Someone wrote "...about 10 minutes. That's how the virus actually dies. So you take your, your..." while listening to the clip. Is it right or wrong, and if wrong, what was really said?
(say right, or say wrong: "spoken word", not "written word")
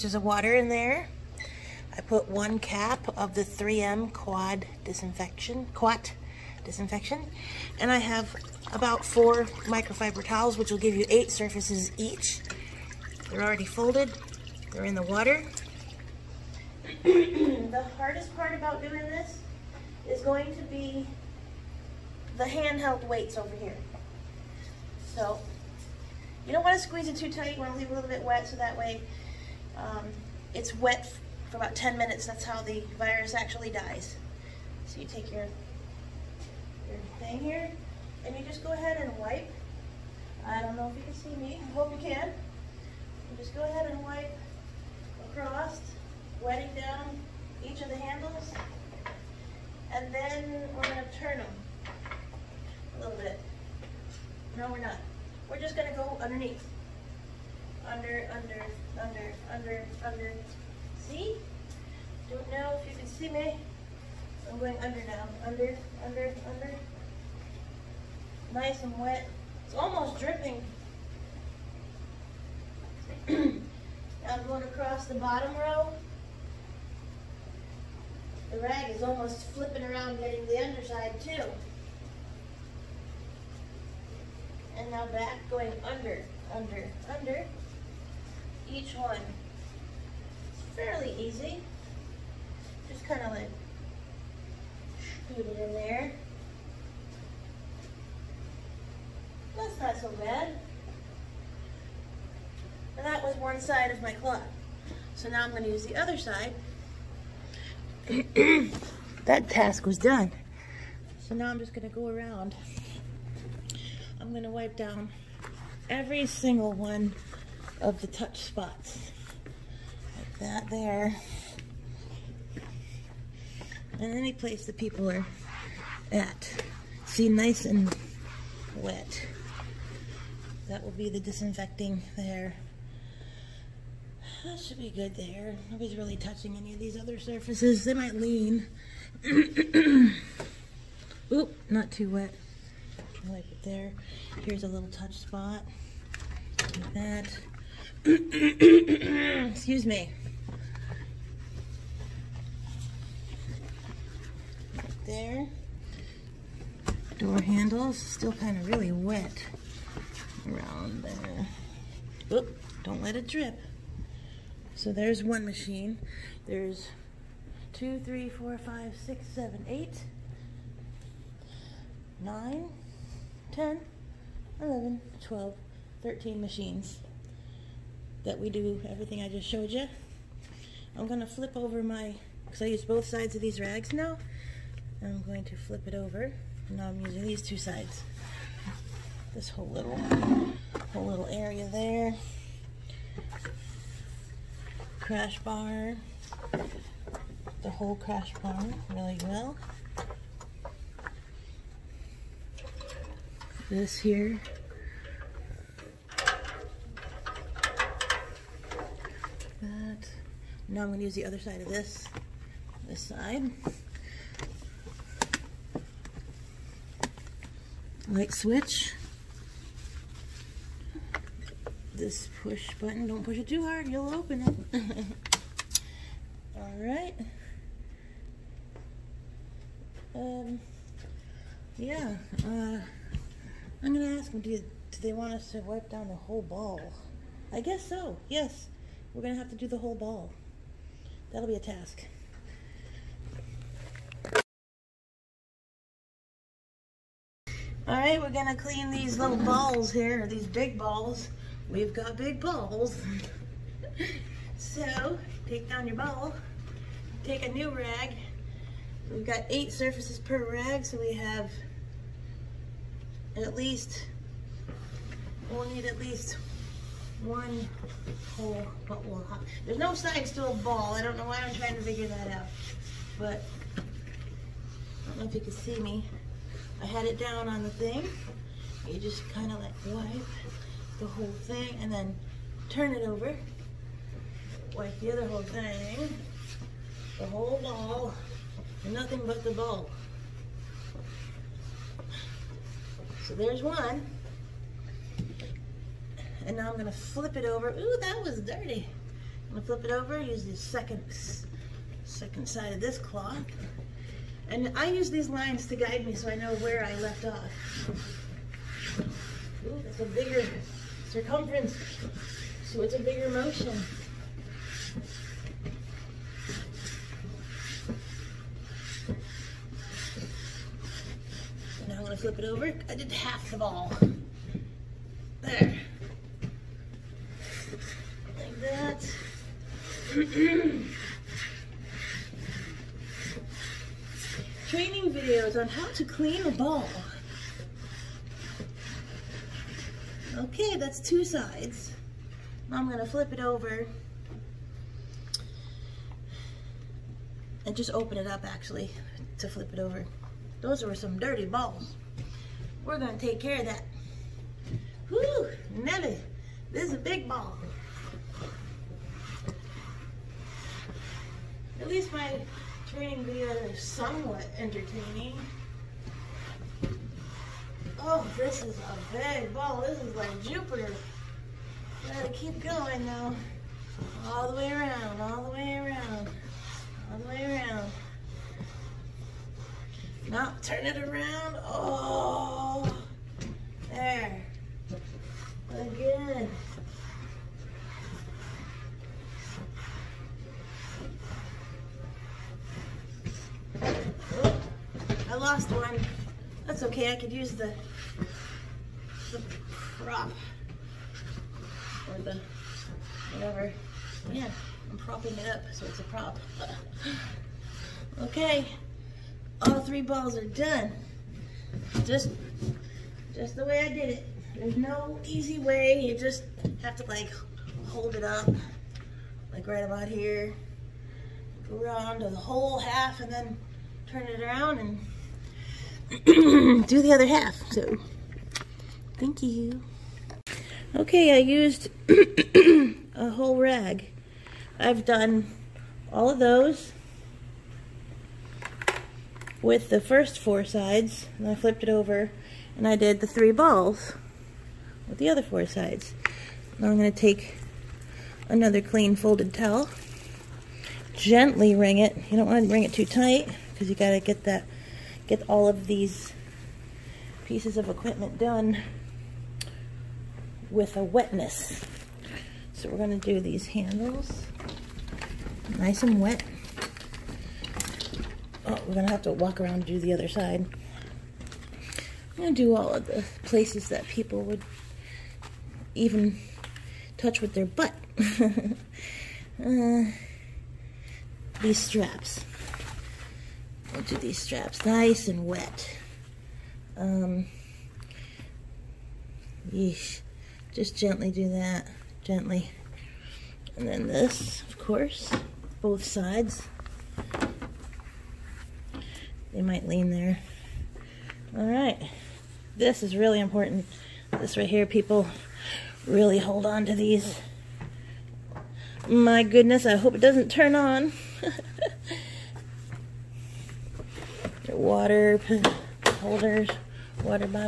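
right.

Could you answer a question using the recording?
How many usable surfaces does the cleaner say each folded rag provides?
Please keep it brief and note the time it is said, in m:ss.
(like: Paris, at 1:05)
8, at 4:19.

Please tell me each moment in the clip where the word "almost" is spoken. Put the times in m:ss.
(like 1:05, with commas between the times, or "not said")
1:09, 1:19.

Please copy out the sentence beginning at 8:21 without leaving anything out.
All right, this is really important.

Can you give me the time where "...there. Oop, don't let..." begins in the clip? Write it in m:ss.
2:41.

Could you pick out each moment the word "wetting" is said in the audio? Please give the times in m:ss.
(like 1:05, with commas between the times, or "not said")
0:46.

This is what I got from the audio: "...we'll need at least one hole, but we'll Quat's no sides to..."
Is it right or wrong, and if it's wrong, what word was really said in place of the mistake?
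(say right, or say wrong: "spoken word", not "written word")
wrong: "There", not "Quat".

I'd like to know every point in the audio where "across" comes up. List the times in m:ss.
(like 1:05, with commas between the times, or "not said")
0:45, 1:14.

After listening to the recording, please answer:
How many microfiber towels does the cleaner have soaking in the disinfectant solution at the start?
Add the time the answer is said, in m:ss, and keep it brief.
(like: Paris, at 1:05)
4, at 0:09.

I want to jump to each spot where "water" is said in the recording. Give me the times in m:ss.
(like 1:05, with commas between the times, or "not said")
0:00, 0:15, 8:34.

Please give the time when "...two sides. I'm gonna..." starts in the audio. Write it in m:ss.
5:40.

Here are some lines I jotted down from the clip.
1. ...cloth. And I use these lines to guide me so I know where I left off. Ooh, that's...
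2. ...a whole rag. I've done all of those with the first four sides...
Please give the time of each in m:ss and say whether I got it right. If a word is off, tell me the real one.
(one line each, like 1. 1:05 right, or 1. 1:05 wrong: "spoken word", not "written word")
1. 5:02 right
2. 7:13 right.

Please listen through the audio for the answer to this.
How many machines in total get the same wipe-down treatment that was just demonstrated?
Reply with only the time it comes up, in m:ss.
2:56.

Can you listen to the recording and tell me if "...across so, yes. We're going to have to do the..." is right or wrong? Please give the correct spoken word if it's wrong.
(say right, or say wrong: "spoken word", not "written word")
wrong: "guess", not "across".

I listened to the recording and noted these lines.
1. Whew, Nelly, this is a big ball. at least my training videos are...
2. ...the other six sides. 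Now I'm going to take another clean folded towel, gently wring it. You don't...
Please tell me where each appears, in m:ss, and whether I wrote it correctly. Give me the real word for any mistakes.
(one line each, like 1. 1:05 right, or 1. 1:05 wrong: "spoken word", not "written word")
1. 5:55 right
2. 7:25 wrong: "four", not "six".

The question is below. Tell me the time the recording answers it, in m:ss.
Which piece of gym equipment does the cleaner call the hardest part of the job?
0:22.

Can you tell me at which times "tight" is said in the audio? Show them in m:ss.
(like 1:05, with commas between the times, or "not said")
0:27, 7:33.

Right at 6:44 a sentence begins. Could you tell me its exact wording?
Yeah, I'm propping it up, so it's a prop.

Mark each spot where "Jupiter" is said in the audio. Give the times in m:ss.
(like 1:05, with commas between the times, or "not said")
6:10.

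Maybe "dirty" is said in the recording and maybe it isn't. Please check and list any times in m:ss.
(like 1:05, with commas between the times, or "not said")
4:58, 5:51.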